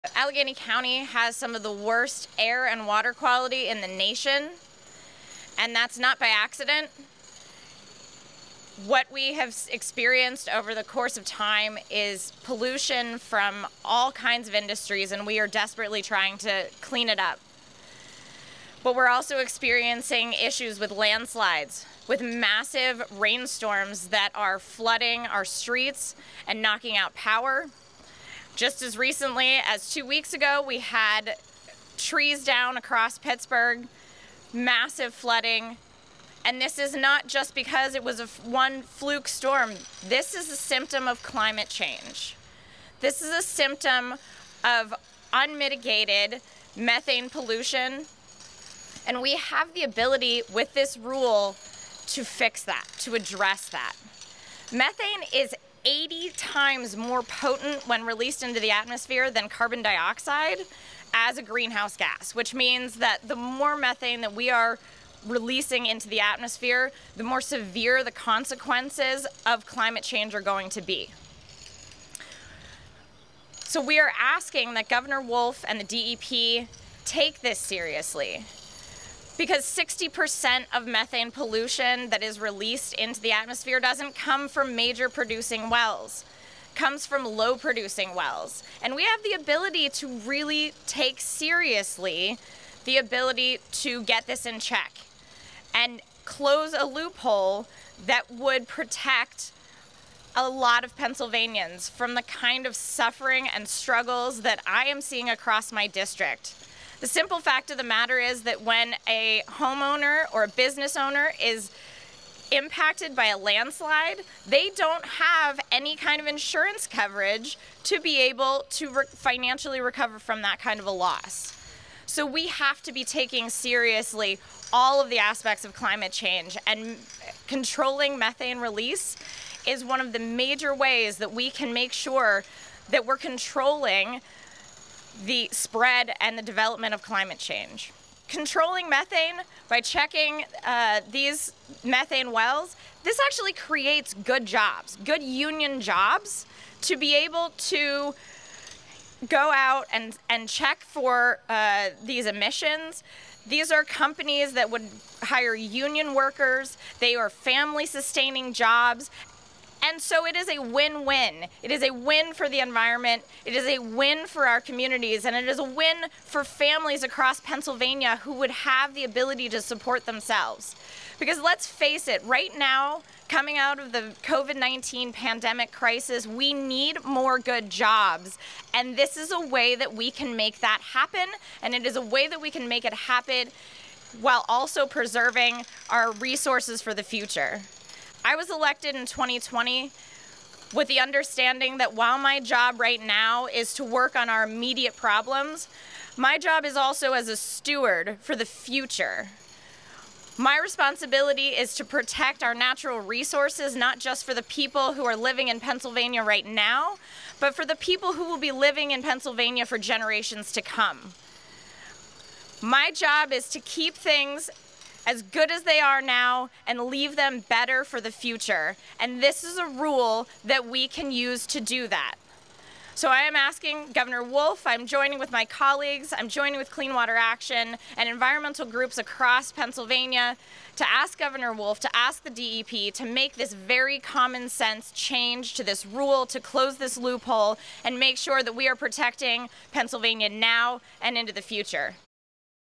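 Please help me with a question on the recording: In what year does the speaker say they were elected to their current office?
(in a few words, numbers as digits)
2020.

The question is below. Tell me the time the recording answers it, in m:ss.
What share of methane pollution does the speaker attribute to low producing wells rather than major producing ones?
1:19.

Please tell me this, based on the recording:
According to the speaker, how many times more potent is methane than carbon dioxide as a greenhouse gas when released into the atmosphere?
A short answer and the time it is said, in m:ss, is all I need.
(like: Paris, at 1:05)
80, at 0:55.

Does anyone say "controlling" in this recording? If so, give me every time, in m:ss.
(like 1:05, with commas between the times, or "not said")
2:07, 2:13, 2:18.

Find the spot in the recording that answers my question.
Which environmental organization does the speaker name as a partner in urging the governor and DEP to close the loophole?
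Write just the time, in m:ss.
3:46.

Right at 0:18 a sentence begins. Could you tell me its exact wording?
But we're also experiencing issues with landslides, with massive rainstorms that are flooding our streets and knocking out power.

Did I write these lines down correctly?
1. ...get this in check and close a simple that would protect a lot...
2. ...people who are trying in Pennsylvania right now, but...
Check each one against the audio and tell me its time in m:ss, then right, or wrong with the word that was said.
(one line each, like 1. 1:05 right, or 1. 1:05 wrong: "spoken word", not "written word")
1. 1:34 wrong: "loophole", not "simple"
2. 3:24 wrong: "living", not "trying".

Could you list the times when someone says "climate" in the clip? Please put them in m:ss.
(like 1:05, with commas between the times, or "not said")
0:41, 1:09, 2:05, 2:17.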